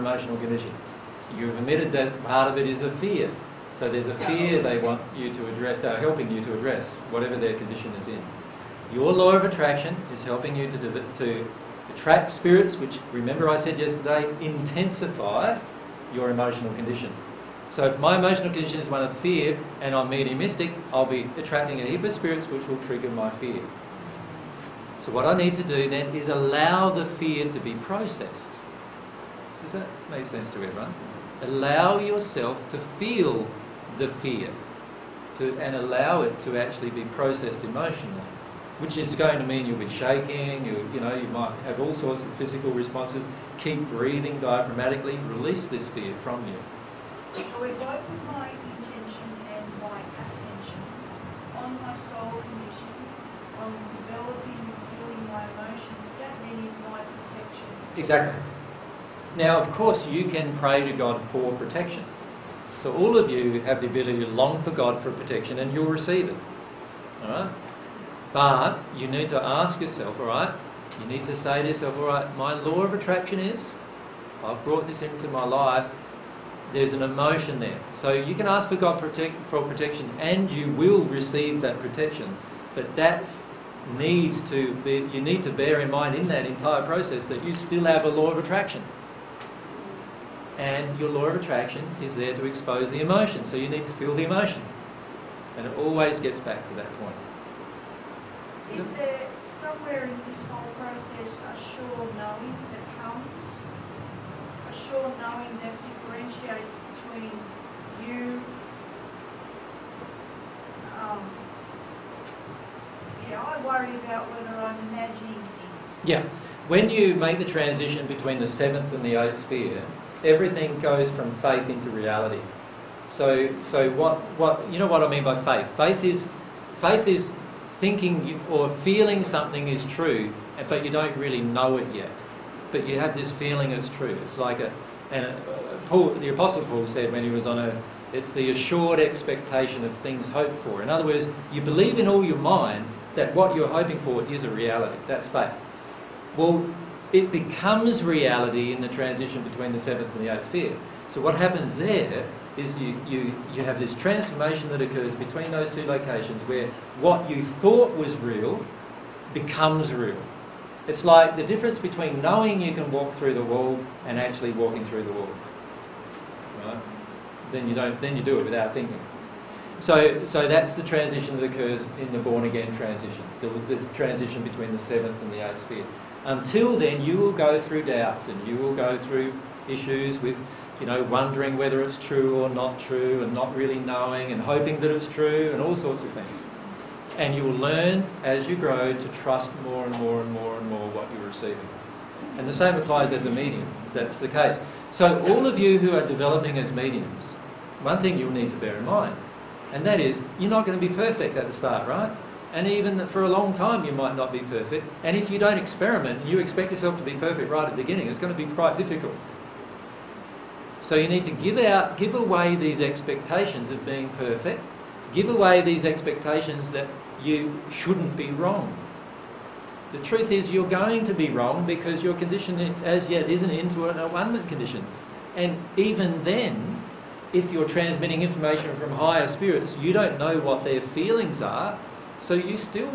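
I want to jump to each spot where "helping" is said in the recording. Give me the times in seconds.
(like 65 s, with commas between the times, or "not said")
5 s, 10 s.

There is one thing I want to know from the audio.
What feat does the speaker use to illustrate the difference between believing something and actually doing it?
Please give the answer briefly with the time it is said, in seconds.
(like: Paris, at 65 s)
Walking through the wall, at 164 s.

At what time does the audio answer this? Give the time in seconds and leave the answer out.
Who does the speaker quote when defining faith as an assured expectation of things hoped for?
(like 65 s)
136 s.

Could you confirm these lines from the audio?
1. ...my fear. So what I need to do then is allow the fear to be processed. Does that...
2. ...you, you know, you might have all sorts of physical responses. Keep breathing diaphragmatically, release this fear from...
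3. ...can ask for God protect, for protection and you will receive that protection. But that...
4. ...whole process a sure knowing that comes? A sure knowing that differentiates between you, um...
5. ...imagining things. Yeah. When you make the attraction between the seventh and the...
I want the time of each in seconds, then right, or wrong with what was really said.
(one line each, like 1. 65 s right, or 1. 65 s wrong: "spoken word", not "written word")
1. 23 s right
2. 40 s right
3. 78 s right
4. 100 s right
5. 114 s wrong: "transition", not "attraction".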